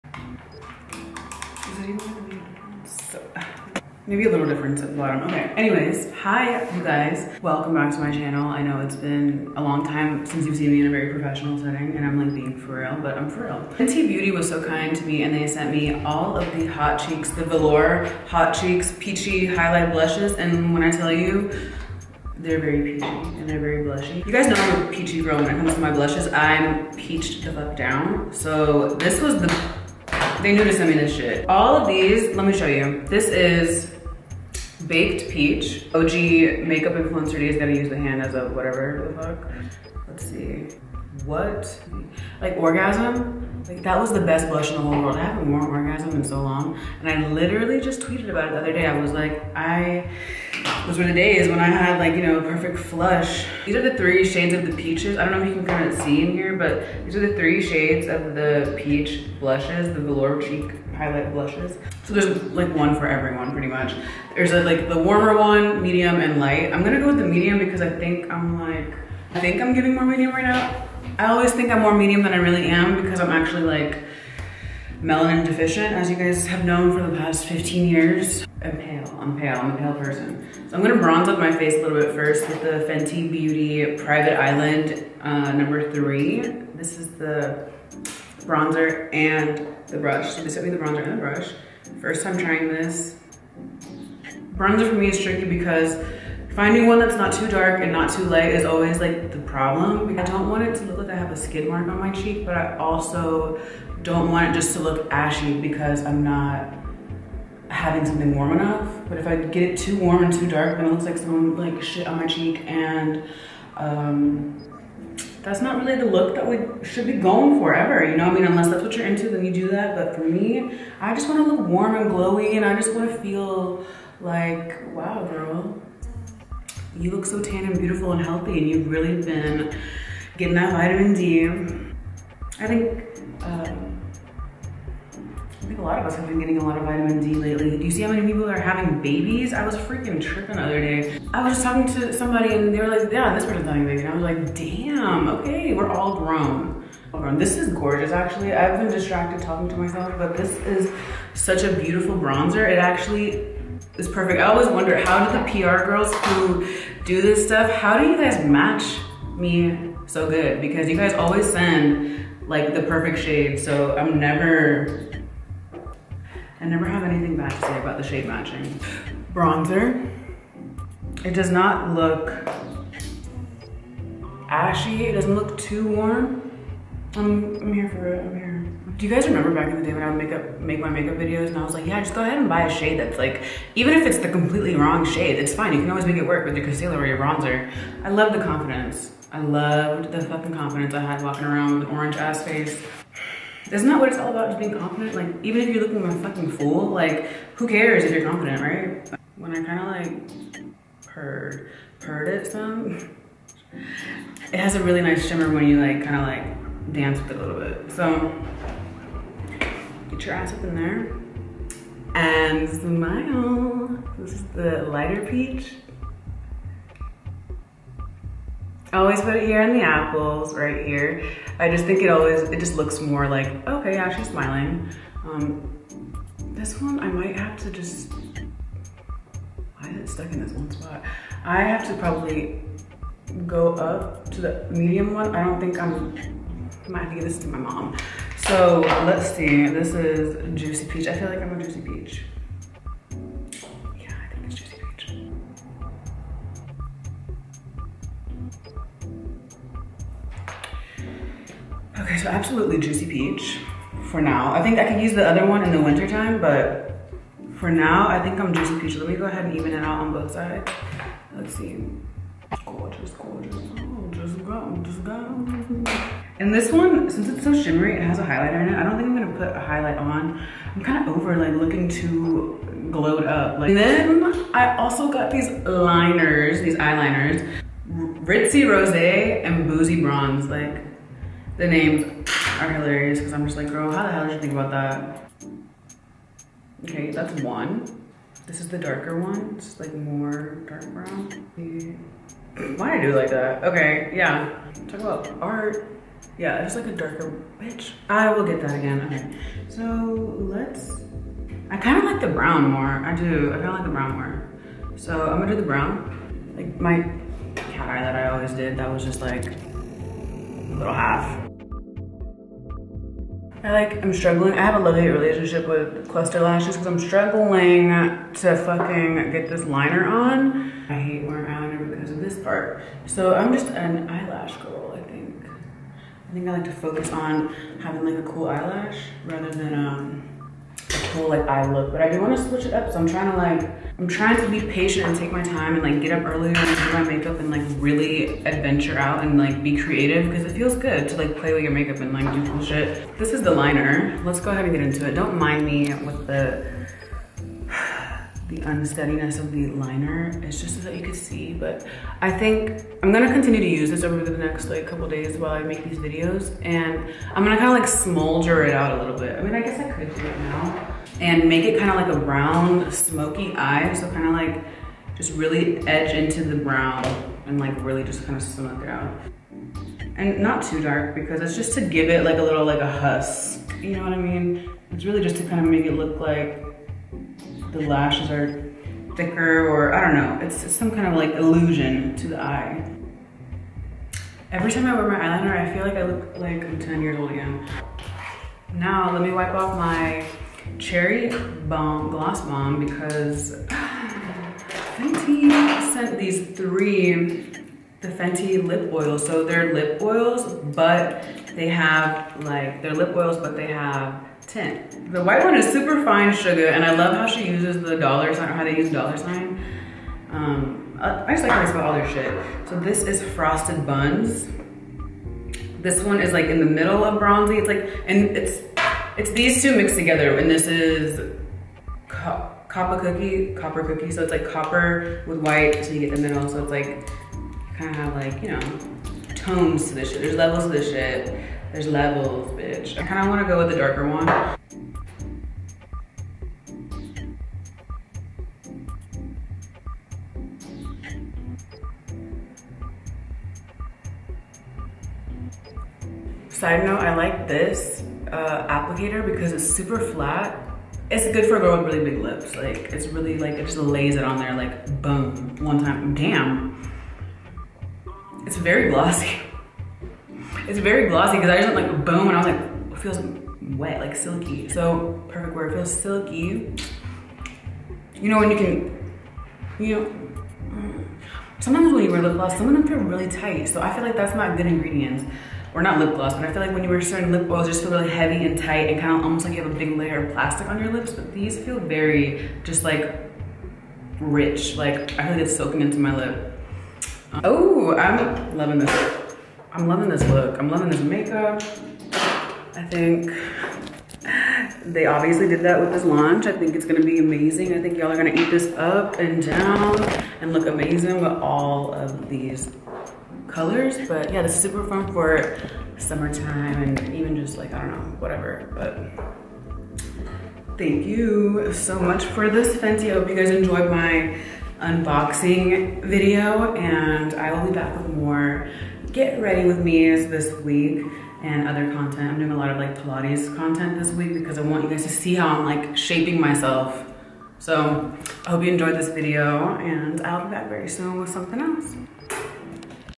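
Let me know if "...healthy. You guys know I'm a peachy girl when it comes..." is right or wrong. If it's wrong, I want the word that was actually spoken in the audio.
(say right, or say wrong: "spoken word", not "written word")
wrong: "blushy", not "healthy".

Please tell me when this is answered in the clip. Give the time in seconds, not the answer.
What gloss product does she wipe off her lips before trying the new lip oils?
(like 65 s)
390 s.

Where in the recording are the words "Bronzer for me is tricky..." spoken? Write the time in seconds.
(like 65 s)
94 s.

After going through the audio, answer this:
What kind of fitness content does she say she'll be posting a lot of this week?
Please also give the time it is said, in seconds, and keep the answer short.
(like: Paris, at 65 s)
Pilates, at 522 s.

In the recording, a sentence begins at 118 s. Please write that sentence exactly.
I mean, unless that's what you're into, then you do that.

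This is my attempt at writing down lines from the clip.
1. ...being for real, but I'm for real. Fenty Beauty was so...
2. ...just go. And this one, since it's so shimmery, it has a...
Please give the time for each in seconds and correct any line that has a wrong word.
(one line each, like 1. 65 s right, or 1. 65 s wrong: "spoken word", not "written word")
1. 12 s right
2. 264 s right.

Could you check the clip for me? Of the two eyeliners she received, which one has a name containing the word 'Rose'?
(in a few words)
Ritzy Rose.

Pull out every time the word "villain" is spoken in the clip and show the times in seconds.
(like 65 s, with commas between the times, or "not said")
not said.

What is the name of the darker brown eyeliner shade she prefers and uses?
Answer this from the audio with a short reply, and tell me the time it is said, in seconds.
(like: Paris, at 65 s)
Boozy Bronze, at 279 s.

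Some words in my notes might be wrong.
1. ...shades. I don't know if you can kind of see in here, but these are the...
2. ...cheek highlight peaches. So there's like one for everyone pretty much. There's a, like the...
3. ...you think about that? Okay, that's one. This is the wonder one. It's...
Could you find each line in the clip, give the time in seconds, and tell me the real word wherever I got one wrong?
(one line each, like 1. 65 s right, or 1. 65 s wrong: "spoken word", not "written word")
1. 54 s wrong: "peaches", not "shades"
2. 60 s wrong: "blushes", not "peaches"
3. 284 s wrong: "darker", not "wonder".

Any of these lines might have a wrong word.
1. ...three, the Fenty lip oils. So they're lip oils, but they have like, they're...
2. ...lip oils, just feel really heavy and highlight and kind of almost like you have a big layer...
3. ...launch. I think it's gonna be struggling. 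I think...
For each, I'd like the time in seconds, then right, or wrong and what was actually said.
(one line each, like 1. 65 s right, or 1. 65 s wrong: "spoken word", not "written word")
1. 396 s right
2. 477 s wrong: "tight", not "highlight"
3. 496 s wrong: "amazing", not "struggling".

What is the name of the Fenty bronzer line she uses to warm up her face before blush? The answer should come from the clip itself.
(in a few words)
Private Island.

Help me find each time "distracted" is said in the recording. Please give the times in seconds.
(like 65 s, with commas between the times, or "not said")
148 s.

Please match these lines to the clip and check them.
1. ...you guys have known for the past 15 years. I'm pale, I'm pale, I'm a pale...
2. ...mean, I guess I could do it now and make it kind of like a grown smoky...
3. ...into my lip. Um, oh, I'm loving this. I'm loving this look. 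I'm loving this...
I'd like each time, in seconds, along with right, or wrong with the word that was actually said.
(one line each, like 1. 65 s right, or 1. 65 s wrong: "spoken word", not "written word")
1. 76 s right
2. 359 s wrong: "brown", not "grown"
3. 485 s right.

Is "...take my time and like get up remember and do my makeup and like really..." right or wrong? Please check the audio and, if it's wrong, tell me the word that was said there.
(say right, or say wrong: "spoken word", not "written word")
wrong: "earlier", not "remember".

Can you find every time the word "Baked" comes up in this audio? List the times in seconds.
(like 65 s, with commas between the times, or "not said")
34 s.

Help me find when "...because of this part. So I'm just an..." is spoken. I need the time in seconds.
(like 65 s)
321 s.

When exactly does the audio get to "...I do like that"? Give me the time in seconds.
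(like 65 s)
292 s.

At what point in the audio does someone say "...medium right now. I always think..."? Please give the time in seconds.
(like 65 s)
70 s.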